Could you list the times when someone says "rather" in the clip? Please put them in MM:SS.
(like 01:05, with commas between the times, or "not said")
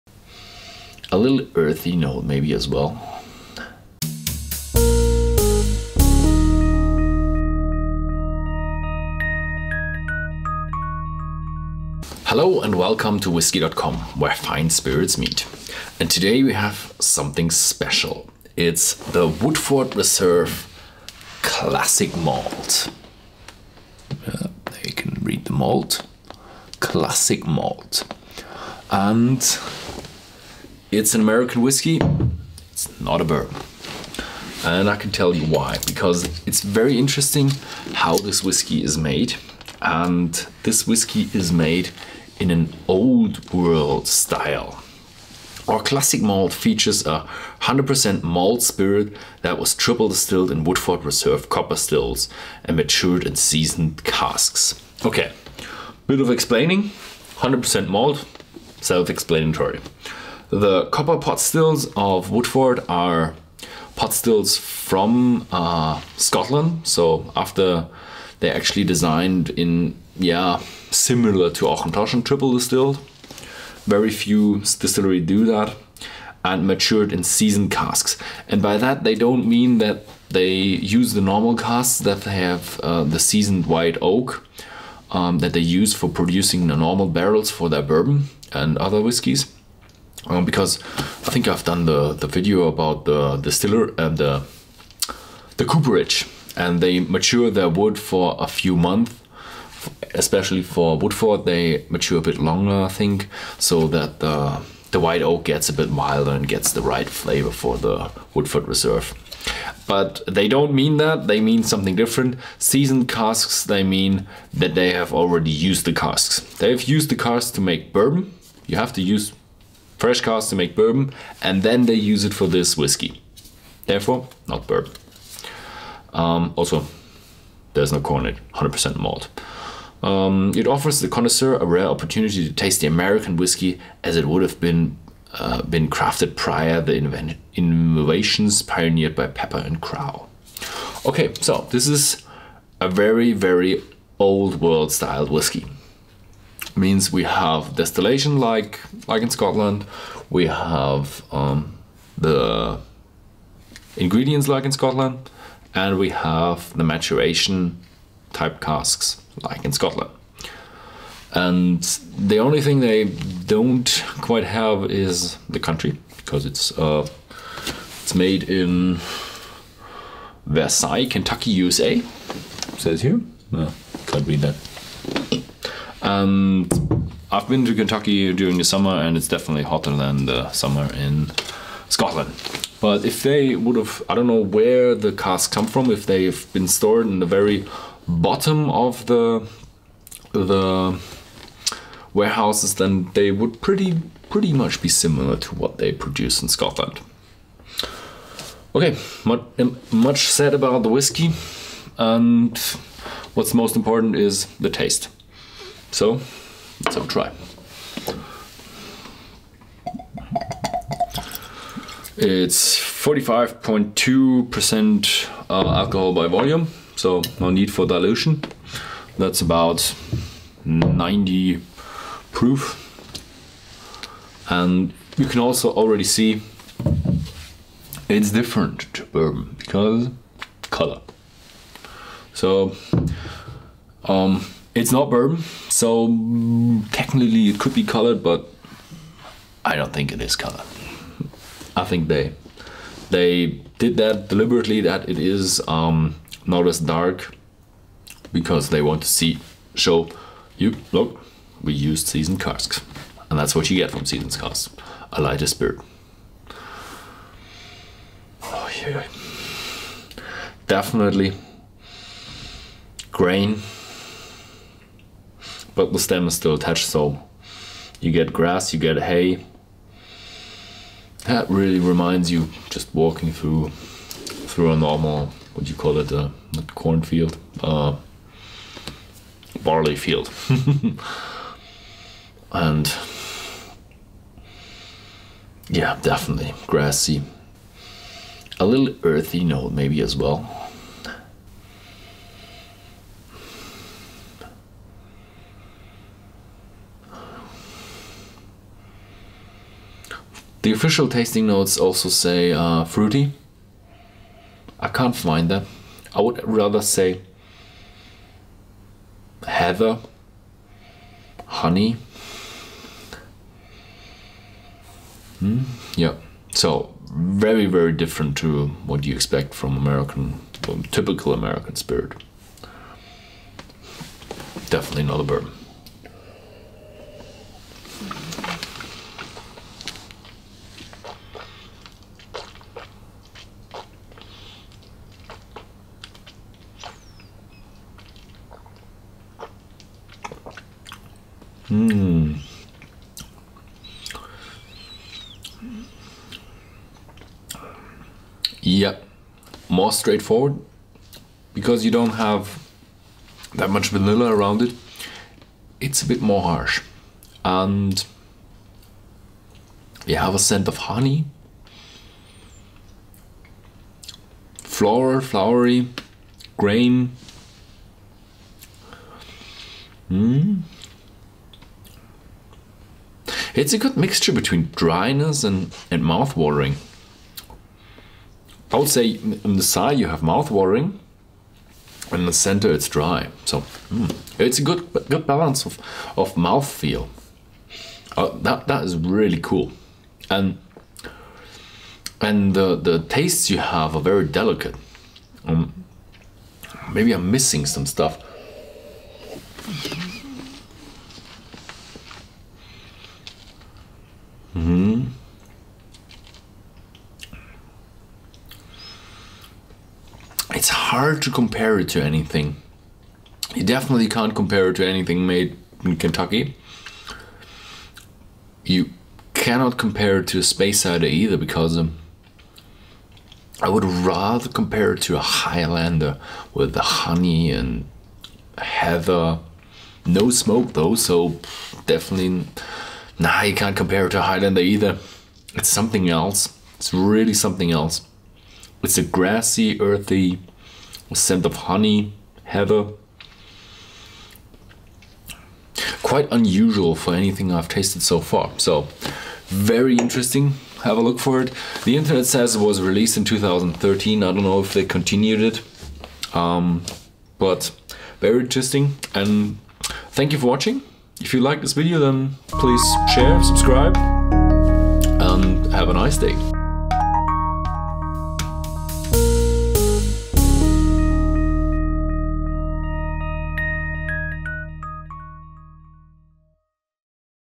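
05:06, 07:03.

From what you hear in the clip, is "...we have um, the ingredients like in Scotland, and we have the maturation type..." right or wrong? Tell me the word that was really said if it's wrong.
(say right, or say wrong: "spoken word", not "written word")
right.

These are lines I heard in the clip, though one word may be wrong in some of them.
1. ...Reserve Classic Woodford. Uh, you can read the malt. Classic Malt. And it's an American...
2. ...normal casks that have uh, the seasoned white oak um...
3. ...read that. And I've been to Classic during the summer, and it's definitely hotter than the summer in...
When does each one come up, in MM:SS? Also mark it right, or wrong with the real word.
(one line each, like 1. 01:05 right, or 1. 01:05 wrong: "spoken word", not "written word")
1. 00:19 wrong: "Malt", not "Woodford"
2. 01:21 right
3. 02:54 wrong: "Kentucky", not "Classic".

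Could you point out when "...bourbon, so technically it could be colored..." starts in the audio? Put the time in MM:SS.
03:55.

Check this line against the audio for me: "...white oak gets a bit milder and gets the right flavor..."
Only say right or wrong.
right.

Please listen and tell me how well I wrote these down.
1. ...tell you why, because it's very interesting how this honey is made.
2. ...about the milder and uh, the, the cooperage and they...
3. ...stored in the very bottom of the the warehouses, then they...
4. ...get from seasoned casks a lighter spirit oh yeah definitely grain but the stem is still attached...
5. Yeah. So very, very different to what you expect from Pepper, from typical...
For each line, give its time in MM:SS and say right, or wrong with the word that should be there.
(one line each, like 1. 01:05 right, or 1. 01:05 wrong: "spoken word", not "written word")
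1. 00:35 wrong: "whiskey", not "honey"
2. 01:32 wrong: "distiller", not "milder"
3. 03:06 right
4. 04:13 right
5. 05:15 wrong: "American", not "Pepper".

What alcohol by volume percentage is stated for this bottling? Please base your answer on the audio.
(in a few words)
45.2%.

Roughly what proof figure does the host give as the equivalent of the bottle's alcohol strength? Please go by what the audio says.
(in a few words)
90 proof.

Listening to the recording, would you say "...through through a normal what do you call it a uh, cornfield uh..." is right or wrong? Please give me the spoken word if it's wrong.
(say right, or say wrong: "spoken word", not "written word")
right.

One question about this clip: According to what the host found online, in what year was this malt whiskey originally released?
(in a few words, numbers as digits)
2013.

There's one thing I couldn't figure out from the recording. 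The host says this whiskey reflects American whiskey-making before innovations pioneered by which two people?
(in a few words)
Pepper and Crow.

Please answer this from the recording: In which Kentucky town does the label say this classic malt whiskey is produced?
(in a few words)
Versailles.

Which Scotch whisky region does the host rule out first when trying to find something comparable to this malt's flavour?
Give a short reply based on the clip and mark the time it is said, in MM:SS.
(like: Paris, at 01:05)
Speyside, at 07:00.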